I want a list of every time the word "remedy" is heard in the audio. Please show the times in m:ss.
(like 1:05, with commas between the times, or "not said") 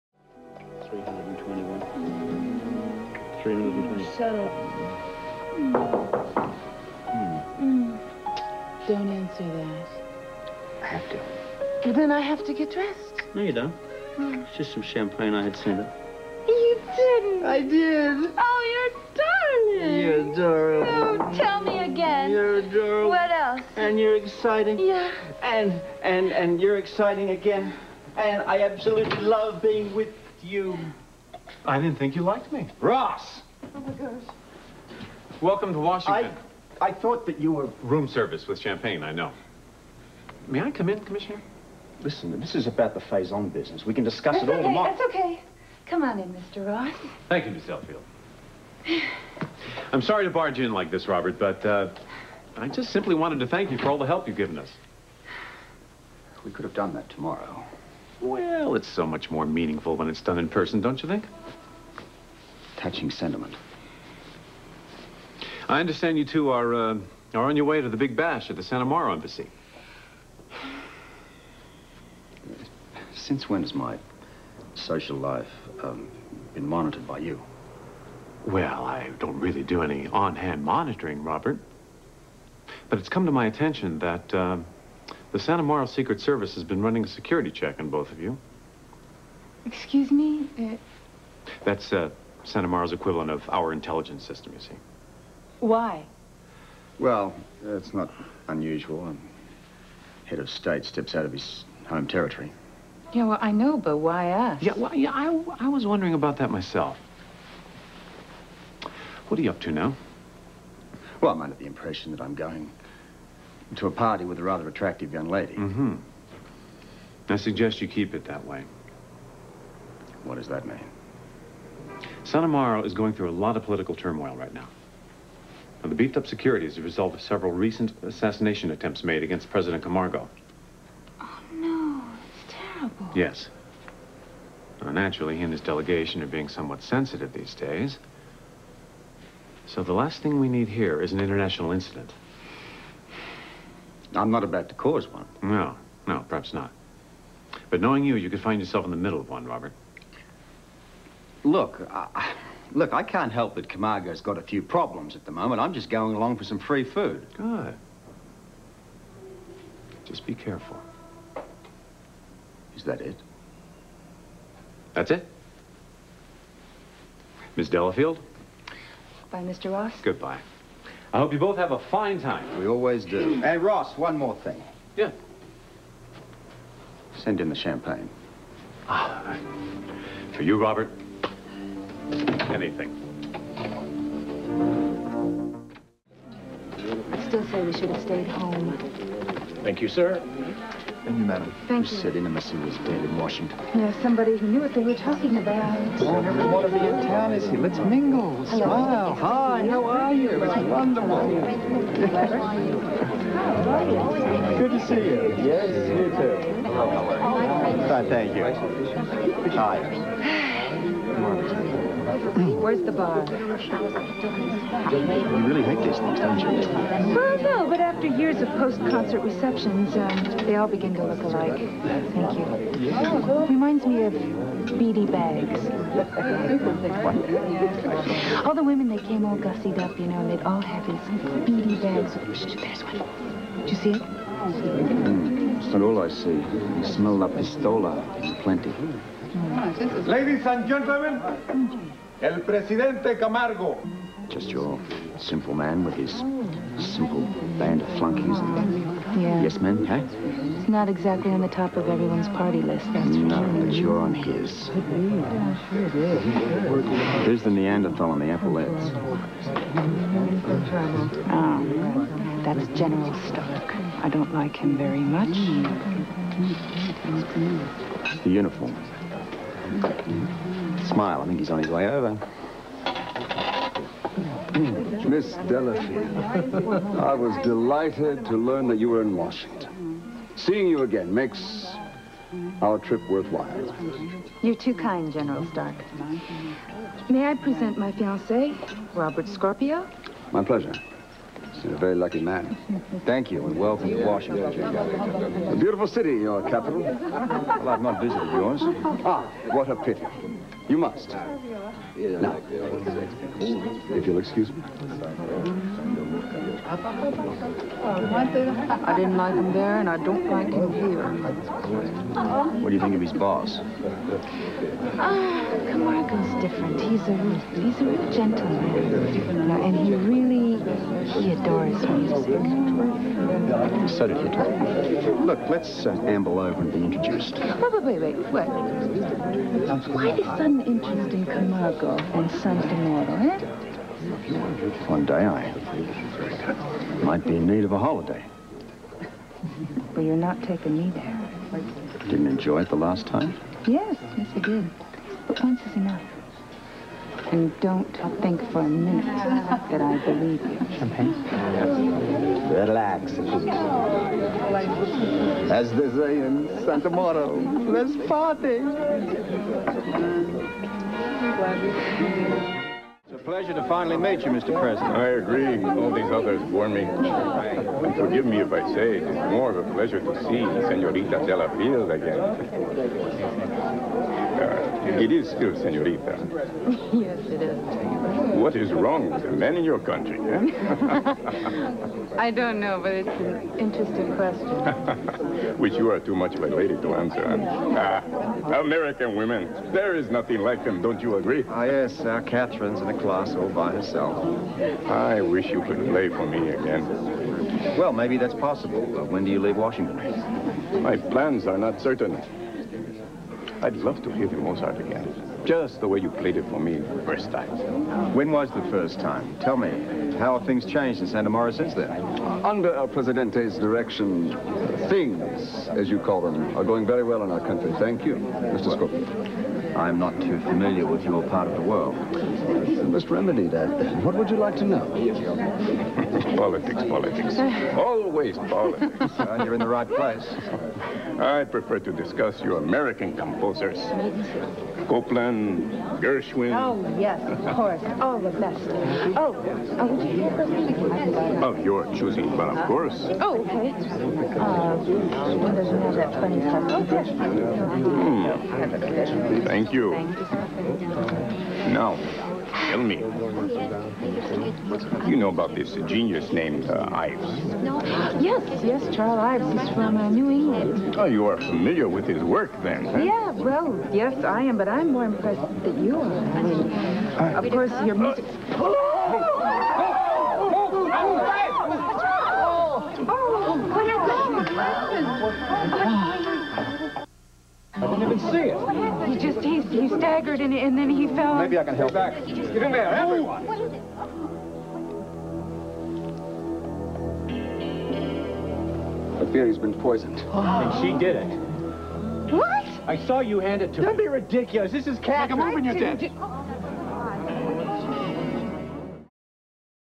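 7:03.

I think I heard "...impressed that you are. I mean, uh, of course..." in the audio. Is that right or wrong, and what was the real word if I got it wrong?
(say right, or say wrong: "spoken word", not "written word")
right.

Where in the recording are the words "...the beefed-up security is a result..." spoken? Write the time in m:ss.
2:05.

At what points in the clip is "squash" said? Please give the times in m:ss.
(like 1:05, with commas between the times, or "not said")
not said.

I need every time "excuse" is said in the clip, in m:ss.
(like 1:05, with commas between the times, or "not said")
1:29, 5:04.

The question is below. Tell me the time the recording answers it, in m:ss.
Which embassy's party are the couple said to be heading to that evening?
1:08.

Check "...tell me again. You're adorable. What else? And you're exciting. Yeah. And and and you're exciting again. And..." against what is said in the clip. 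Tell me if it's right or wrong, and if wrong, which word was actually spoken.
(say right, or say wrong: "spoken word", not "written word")
right.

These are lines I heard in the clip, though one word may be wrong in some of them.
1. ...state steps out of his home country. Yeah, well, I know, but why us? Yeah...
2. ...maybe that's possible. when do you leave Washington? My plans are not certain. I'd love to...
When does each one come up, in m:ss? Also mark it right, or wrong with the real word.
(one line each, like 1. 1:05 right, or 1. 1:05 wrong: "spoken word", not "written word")
1. 1:40 wrong: "territory", not "country"
2. 6:37 right.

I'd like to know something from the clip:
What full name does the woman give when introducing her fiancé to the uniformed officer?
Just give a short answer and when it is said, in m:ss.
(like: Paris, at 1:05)
Robert Scorpio, at 4:48.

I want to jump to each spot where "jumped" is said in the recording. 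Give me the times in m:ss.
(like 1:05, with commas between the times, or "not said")
not said.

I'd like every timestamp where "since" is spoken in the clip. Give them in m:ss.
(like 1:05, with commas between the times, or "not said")
1:13, 6:51.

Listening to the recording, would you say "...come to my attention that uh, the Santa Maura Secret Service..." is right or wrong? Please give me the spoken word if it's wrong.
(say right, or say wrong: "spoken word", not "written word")
right.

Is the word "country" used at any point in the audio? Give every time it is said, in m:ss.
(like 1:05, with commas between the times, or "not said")
6:19, 6:57.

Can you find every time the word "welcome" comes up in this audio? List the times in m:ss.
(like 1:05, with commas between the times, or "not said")
0:35, 4:53.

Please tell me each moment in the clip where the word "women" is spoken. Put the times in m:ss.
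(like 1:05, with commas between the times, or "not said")
3:48, 6:29.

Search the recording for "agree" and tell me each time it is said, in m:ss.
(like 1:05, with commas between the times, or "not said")
6:05, 6:31.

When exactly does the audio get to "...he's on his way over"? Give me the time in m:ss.
4:31.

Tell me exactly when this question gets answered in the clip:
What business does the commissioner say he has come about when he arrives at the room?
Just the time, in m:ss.
0:42.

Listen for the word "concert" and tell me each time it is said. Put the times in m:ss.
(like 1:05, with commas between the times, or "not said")
3:38.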